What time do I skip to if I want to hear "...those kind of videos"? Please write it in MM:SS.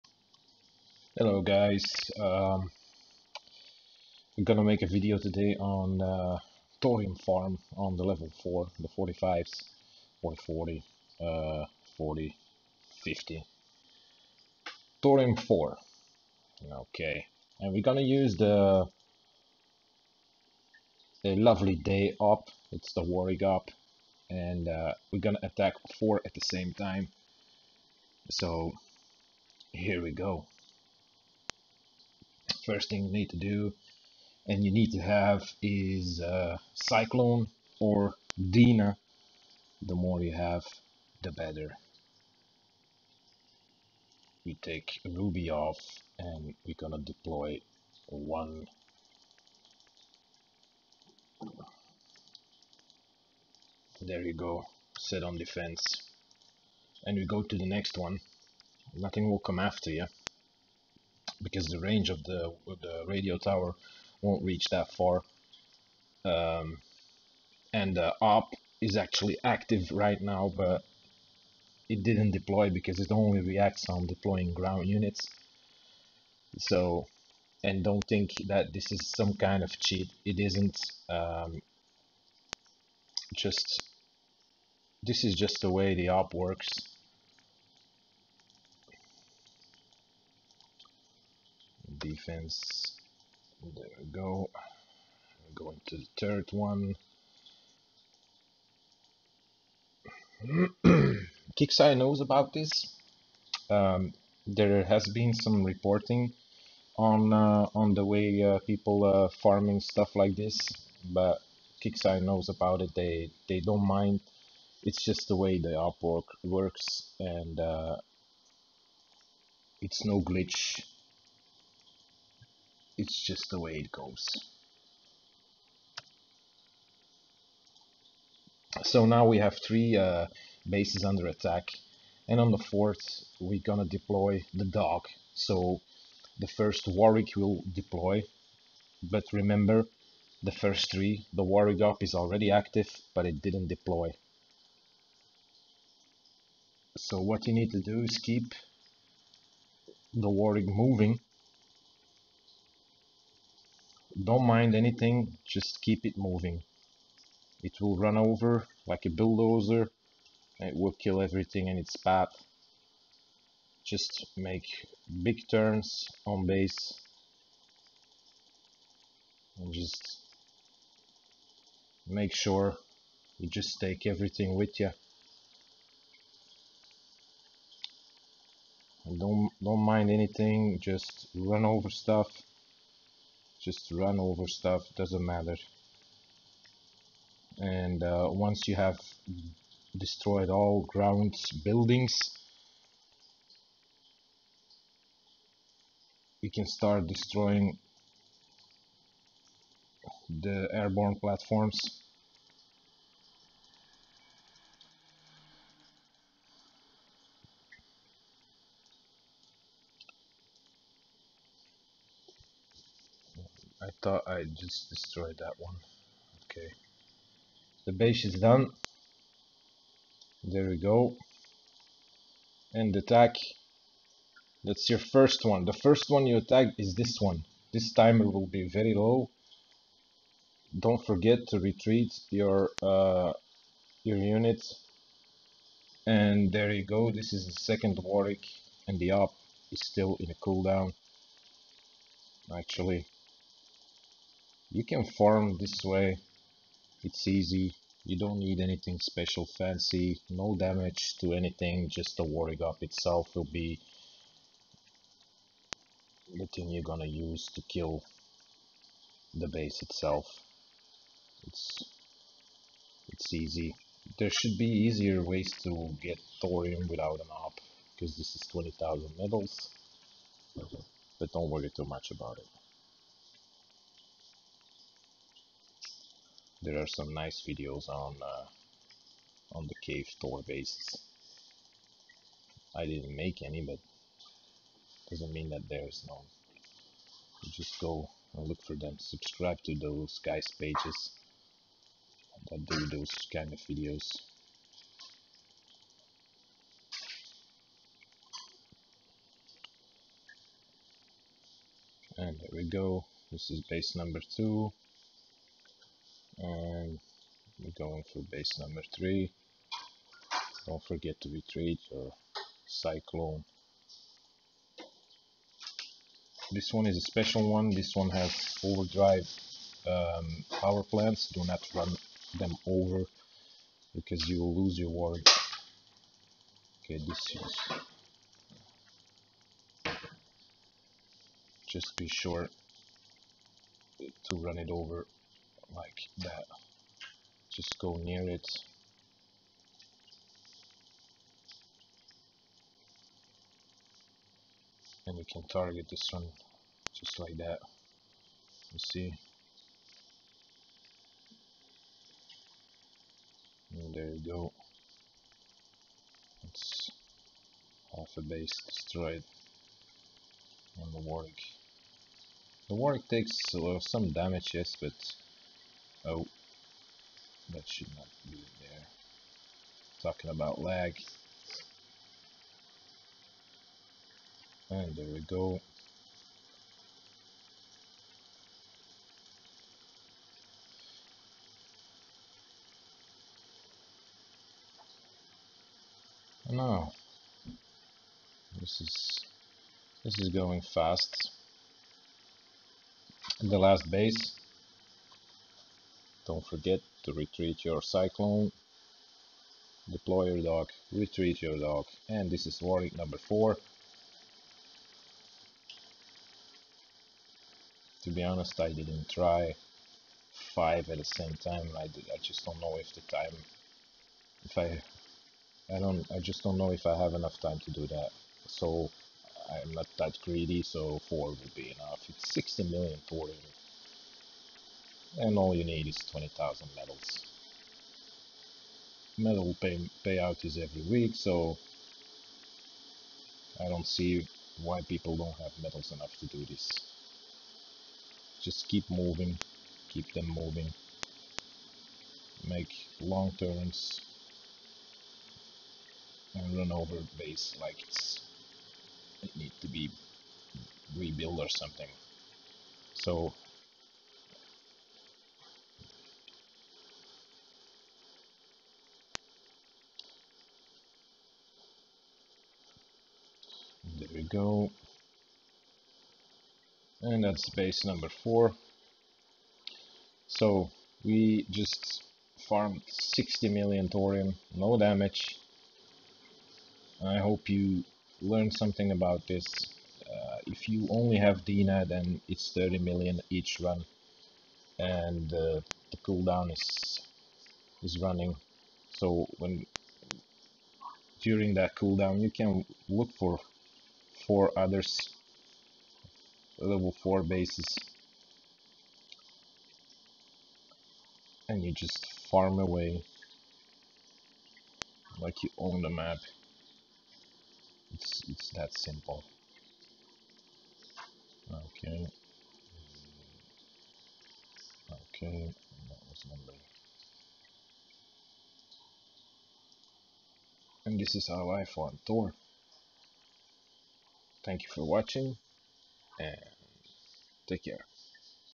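04:52.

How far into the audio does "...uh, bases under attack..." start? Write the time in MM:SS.
02:09.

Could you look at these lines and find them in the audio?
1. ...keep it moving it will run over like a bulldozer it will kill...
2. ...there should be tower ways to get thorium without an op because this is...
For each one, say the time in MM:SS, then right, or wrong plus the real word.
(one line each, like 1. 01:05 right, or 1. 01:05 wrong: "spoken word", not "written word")
1. 02:35 right
2. 04:24 wrong: "easier", not "tower".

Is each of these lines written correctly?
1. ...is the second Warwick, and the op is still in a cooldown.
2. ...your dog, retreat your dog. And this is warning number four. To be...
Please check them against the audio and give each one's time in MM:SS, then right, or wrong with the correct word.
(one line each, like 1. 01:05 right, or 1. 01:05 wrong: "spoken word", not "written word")
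1. 03:57 right
2. 06:40 right.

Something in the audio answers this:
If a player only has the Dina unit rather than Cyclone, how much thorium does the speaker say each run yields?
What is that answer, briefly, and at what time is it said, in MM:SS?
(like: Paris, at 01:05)
30 million, at 08:02.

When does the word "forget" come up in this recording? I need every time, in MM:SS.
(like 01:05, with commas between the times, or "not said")
03:51, 05:10, 06:36.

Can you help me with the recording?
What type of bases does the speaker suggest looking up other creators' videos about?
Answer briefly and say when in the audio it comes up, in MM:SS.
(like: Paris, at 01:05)
cave tour bases, at 04:39.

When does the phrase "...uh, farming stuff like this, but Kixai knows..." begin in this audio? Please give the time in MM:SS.
01:49.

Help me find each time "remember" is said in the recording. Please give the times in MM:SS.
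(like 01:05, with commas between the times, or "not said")
02:19.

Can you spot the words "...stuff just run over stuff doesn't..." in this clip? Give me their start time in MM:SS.
03:01.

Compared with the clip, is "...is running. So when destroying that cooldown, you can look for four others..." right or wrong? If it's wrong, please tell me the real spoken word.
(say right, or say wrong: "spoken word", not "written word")
wrong: "during", not "destroying".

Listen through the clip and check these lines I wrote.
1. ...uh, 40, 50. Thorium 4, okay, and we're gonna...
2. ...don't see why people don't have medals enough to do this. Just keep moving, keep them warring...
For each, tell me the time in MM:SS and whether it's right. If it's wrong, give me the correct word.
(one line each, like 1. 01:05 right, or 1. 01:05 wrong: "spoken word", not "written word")
1. 00:11 right
2. 07:13 wrong: "moving", not "warring".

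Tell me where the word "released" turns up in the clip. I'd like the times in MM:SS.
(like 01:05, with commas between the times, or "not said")
not said.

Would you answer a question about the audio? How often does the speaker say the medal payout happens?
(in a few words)
every week.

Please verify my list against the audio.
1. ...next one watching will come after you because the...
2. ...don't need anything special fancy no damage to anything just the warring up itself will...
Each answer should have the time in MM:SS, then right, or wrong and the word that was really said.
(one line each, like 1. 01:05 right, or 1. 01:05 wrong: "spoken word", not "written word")
1. 00:57 wrong: "nothing", not "watching"
2. 04:08 right.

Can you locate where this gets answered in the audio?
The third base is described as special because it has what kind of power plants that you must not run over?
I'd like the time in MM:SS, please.
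05:18.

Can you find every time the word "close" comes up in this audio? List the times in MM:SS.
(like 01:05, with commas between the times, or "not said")
not said.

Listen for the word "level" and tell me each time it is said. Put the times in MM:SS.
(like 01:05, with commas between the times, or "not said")
00:08, 08:16.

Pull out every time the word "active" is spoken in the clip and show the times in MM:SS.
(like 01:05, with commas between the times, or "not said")
01:09, 02:22.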